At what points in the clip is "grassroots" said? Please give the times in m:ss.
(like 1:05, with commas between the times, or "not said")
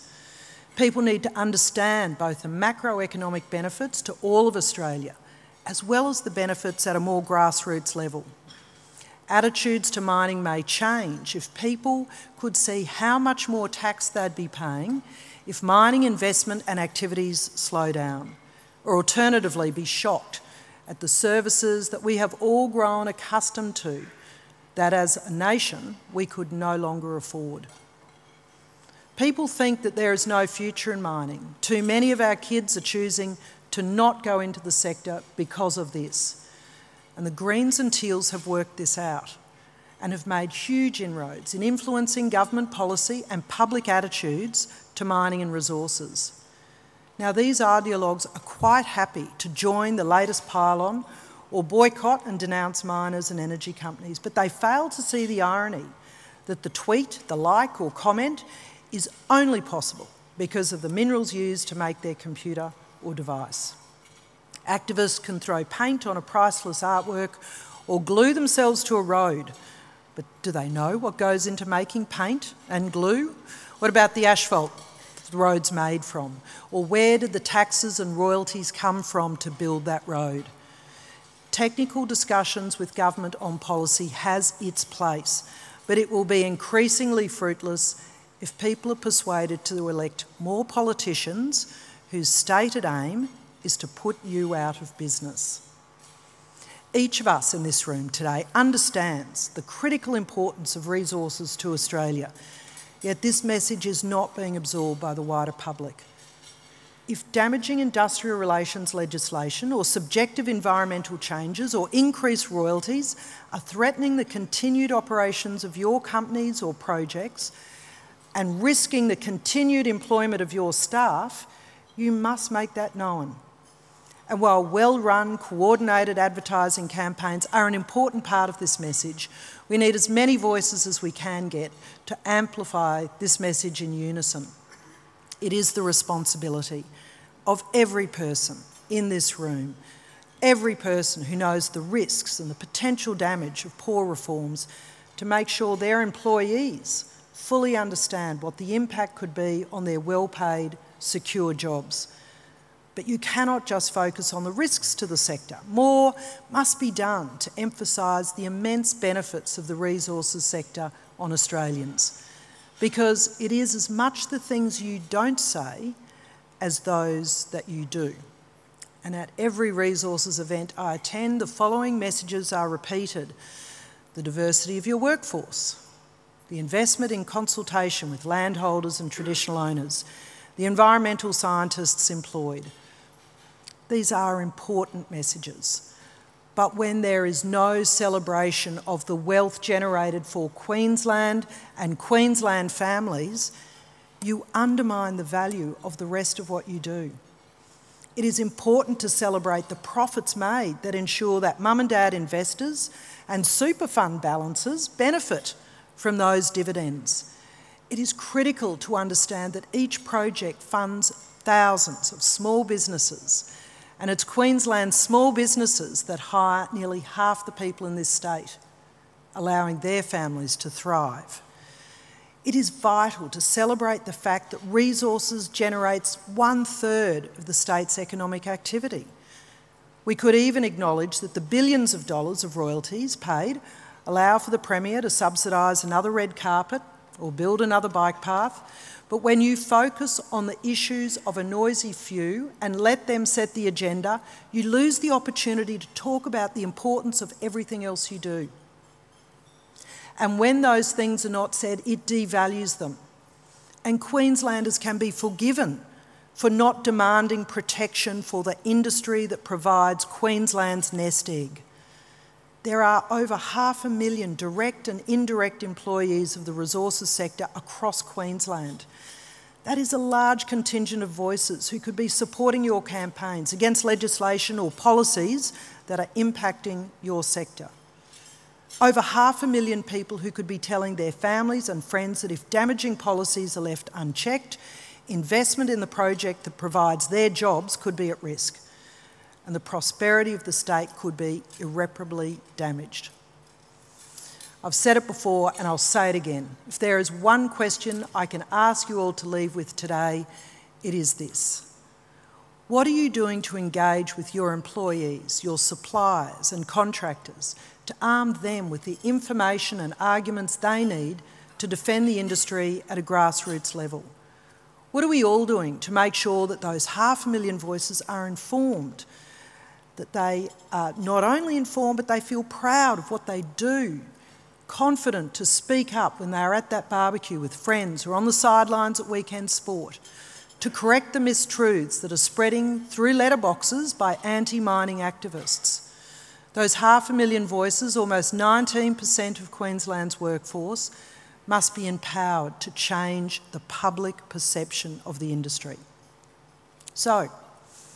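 0:07, 5:13.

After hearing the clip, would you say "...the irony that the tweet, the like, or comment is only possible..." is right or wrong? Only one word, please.
right.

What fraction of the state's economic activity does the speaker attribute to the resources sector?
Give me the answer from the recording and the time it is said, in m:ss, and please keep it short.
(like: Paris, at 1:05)
One third, at 3:46.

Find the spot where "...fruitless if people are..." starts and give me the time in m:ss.
1:27.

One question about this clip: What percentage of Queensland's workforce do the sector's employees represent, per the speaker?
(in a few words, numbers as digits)
Almost 19%.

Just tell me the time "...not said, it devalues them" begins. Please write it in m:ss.
4:11.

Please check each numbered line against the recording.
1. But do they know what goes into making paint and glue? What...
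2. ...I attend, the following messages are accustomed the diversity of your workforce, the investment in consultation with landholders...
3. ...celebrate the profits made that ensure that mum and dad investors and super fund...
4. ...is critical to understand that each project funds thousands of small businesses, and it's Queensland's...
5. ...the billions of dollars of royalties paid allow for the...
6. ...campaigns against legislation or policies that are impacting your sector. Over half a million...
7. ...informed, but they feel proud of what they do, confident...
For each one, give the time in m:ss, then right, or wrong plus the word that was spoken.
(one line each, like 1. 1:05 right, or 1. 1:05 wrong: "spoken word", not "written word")
1. 1:10 right
2. 2:50 wrong: "repeated", not "accustomed"
3. 3:19 right
4. 3:27 right
5. 3:51 right
6. 4:32 right
7. 5:21 right.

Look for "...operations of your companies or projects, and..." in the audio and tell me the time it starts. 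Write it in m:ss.
1:54.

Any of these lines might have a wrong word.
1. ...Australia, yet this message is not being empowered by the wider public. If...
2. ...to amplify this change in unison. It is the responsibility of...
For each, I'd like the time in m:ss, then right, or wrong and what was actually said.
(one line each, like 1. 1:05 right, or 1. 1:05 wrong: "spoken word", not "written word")
1. 1:41 wrong: "absorbed", not "empowered"
2. 2:12 wrong: "message", not "change".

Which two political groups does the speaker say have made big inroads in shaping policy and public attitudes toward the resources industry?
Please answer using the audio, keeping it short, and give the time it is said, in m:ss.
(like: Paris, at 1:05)
Greens and Teals, at 0:37.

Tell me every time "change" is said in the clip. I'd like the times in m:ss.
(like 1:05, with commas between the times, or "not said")
0:10, 1:51, 5:42.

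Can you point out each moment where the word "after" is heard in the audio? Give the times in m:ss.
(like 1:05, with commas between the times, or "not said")
not said.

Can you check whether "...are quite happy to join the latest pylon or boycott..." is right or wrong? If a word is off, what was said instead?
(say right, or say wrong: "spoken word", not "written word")
right.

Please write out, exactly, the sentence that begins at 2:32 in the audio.
But you cannot just focus on the risks to the sector.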